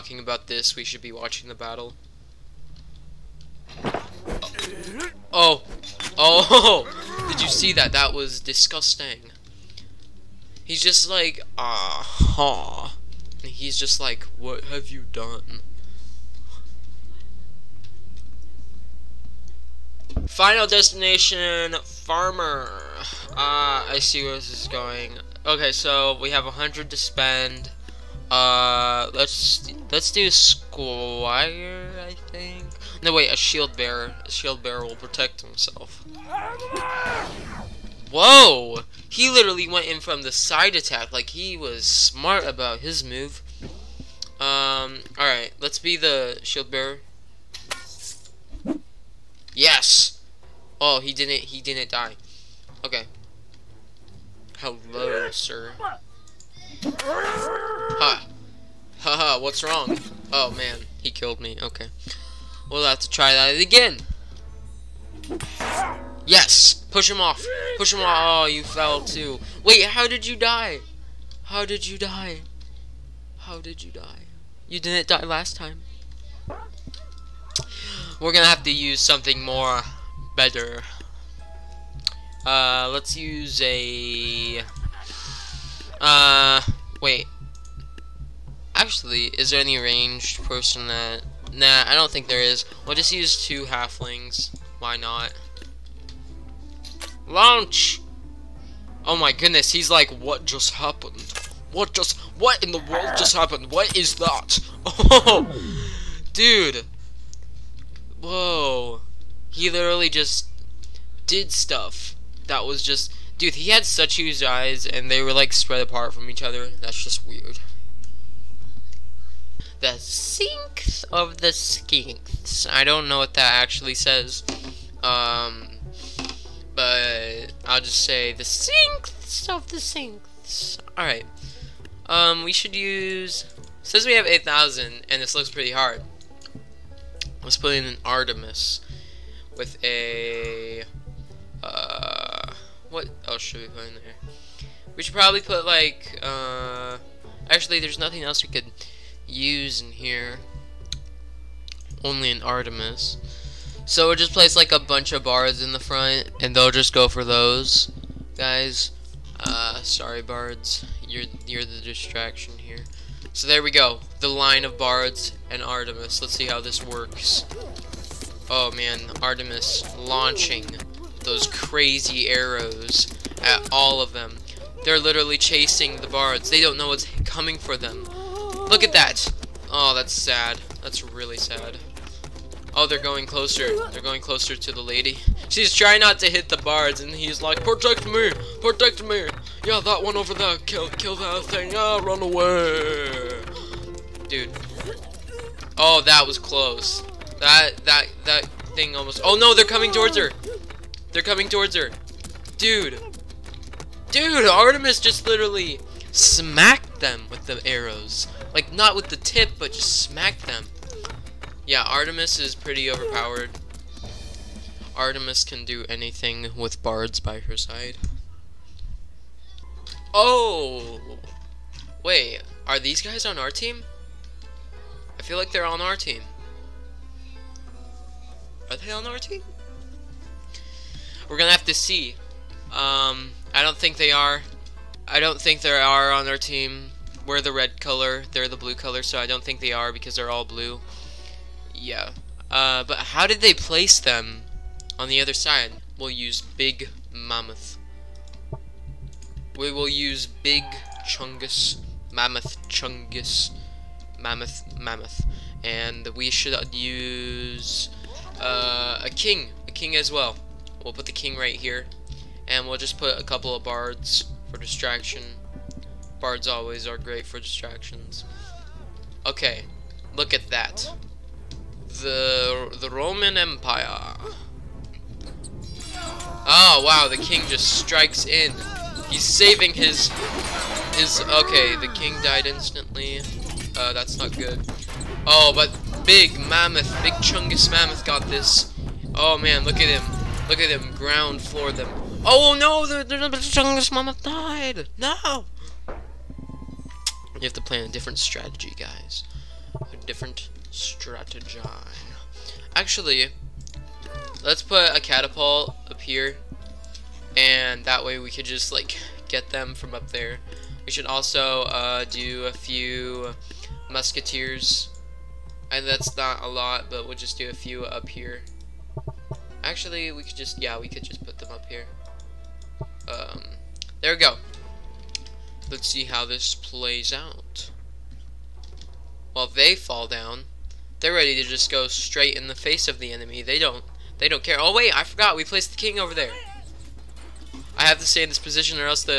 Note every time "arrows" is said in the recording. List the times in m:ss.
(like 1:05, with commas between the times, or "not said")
2:52, 3:27.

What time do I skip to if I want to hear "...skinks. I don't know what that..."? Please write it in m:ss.
2:01.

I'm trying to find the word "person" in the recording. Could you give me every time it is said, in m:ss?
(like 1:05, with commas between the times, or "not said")
1:30.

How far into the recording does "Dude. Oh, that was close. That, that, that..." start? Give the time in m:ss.
3:14.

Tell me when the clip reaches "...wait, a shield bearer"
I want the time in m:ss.
0:33.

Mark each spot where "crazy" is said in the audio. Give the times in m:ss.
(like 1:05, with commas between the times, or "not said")
2:51.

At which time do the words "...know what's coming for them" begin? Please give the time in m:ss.
2:56.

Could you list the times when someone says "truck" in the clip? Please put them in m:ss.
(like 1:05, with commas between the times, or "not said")
not said.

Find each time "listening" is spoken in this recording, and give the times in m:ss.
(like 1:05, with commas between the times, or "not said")
not said.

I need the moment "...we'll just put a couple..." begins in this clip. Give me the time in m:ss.
4:22.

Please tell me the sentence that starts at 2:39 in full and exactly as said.
Uh, sorry, bards, you're you're the distraction here.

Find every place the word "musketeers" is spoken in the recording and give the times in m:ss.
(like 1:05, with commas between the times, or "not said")
5:13.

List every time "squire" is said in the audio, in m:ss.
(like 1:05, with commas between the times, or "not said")
0:30.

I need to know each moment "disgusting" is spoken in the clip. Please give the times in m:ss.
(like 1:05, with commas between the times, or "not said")
0:08.